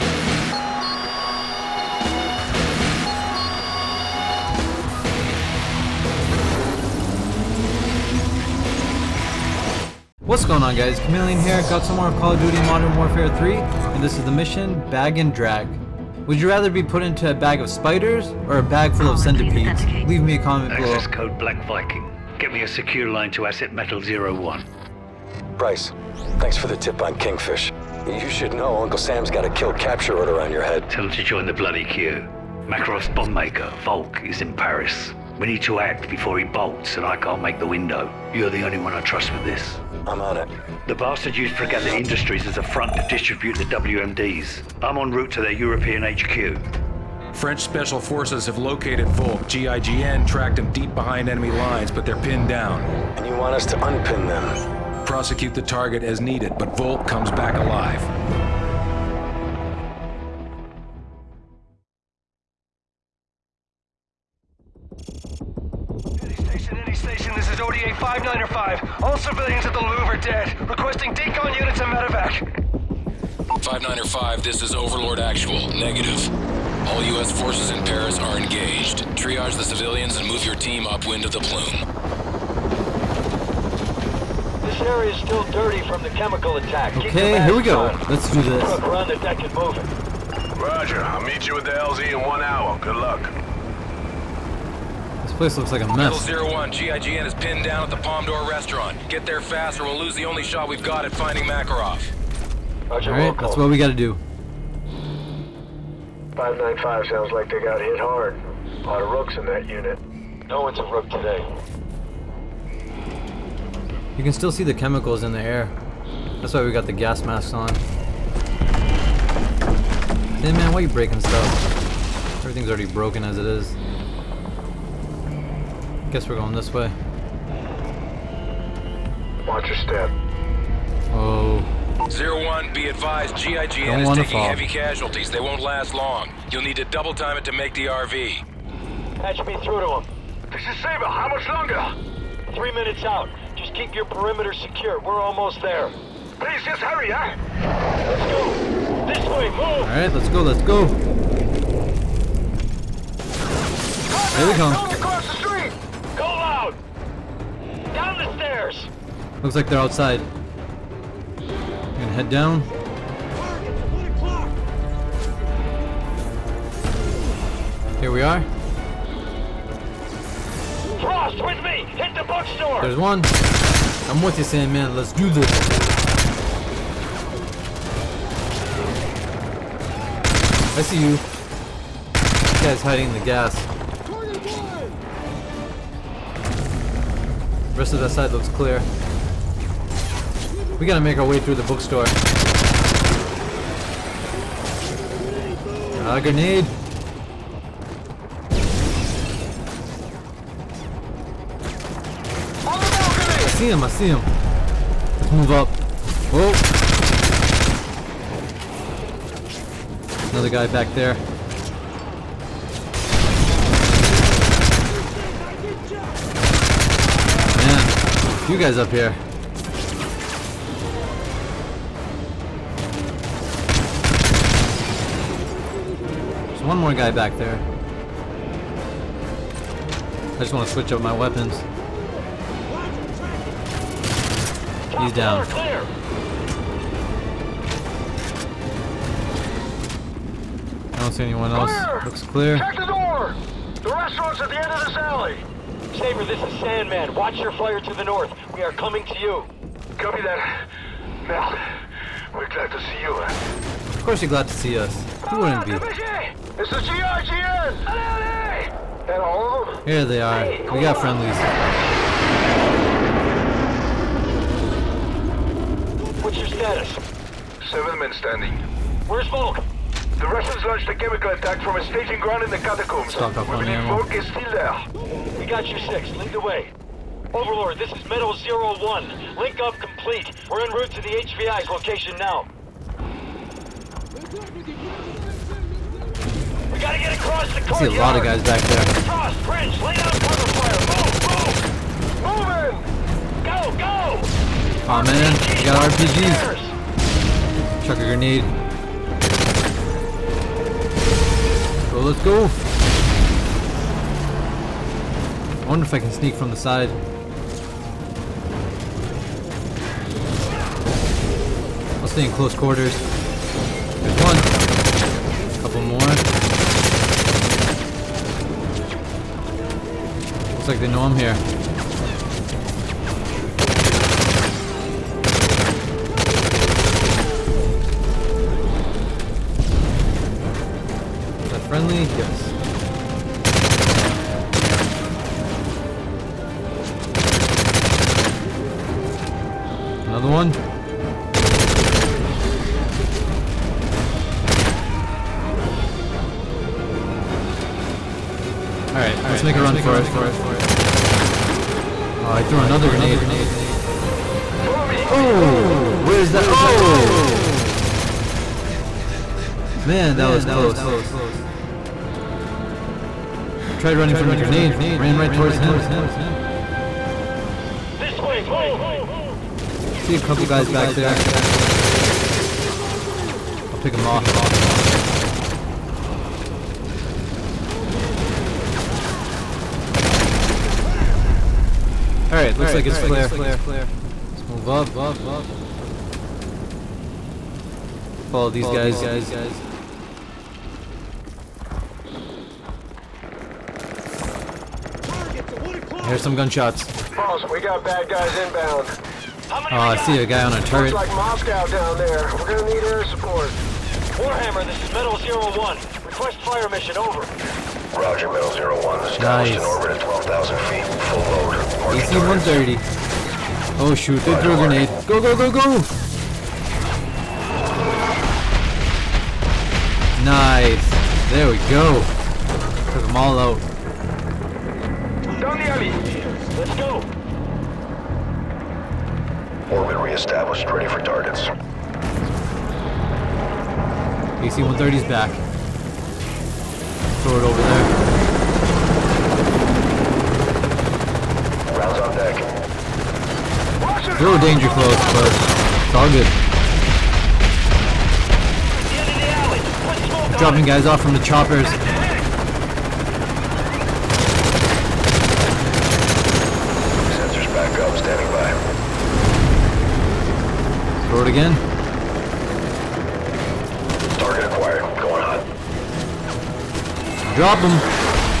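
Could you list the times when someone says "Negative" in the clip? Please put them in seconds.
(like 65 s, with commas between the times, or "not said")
75 s.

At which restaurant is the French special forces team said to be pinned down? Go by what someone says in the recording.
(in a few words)
Palme d'Or.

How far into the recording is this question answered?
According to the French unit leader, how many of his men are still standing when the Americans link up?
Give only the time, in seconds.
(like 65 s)
267 s.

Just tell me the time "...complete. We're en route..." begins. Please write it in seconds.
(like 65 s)
279 s.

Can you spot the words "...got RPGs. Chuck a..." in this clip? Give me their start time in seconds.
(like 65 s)
295 s.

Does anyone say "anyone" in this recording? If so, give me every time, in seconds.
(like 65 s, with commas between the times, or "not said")
241 s.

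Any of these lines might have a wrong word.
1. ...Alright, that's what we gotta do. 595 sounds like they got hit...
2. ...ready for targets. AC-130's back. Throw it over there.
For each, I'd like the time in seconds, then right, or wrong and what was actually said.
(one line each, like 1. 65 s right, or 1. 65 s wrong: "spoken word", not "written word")
1. 103 s right
2. 430 s right.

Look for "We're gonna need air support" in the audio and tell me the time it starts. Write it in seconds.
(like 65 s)
402 s.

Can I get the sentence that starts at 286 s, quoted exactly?
We gotta get across the courtyard.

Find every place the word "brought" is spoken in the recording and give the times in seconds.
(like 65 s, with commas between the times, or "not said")
not said.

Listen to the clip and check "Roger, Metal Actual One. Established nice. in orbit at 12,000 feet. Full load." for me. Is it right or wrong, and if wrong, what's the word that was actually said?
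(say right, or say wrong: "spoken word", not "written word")
wrong: "Zero", not "Actual".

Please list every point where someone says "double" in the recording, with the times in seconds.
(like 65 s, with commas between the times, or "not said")
136 s.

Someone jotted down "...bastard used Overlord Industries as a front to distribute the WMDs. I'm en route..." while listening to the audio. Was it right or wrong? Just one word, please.
wrong.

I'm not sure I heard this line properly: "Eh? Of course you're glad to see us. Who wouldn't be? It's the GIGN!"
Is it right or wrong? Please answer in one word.
wrong.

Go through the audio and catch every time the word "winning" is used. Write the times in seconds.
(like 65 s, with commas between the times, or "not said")
not said.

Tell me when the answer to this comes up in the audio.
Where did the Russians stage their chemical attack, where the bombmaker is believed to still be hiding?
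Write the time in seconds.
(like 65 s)
272 s.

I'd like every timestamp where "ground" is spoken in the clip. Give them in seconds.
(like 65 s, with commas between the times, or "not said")
272 s.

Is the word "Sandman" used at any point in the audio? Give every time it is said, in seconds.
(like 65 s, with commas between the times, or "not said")
174 s, 246 s.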